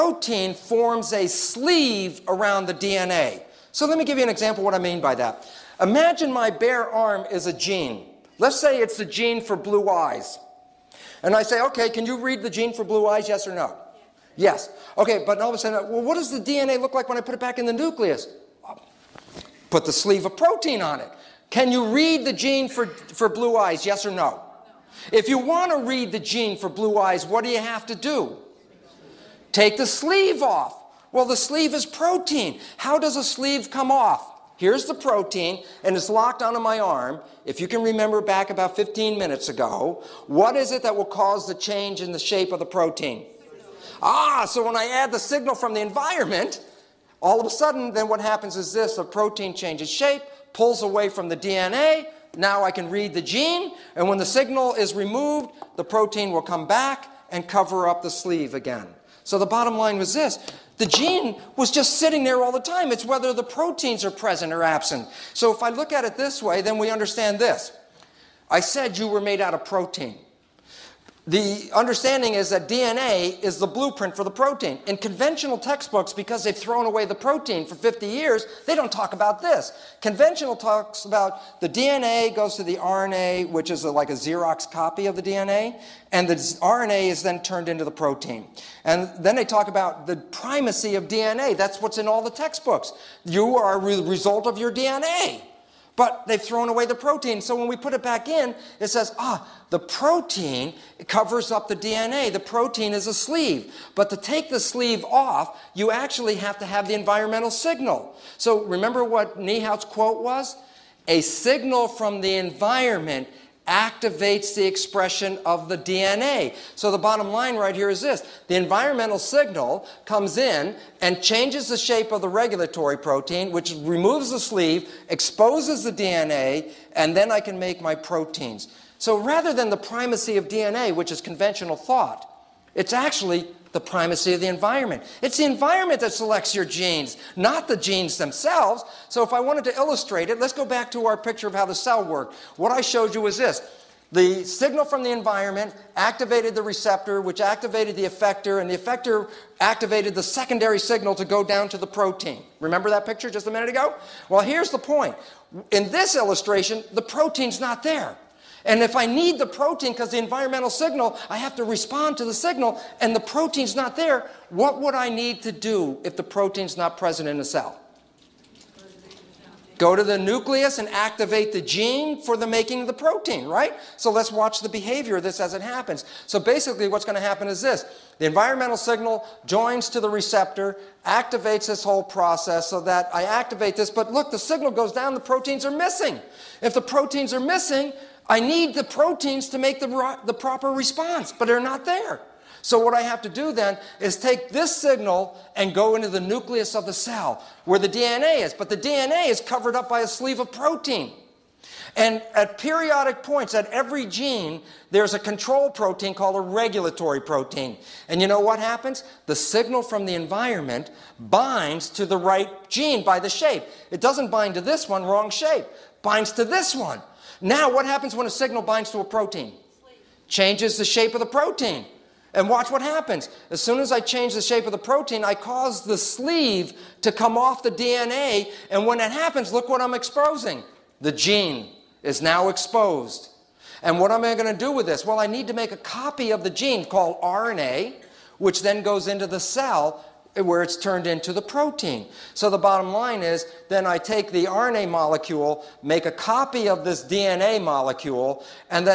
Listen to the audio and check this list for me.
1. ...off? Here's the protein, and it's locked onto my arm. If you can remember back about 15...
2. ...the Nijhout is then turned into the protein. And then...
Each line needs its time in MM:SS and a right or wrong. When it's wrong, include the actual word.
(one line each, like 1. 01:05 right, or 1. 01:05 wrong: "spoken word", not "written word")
1. 00:33 right
2. 01:26 wrong: "RNA", not "Nijhout".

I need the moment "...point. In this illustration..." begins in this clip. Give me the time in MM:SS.
02:34.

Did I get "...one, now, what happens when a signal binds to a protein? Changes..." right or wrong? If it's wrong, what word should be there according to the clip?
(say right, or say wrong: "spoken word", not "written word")
right.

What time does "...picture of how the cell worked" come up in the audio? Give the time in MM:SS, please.
02:21.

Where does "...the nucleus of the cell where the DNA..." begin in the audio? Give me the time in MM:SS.
03:16.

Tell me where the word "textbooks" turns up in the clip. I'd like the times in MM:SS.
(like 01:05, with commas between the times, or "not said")
01:15, 01:32.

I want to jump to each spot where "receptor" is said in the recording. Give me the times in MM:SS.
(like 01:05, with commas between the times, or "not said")
02:26, 03:00.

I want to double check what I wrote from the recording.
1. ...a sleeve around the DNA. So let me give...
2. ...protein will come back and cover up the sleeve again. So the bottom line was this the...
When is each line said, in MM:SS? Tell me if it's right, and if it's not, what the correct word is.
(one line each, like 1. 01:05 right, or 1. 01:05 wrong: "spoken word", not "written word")
1. 00:01 right
2. 00:55 right.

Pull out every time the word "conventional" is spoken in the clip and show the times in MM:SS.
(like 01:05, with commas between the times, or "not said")
01:14, 01:20, 02:11.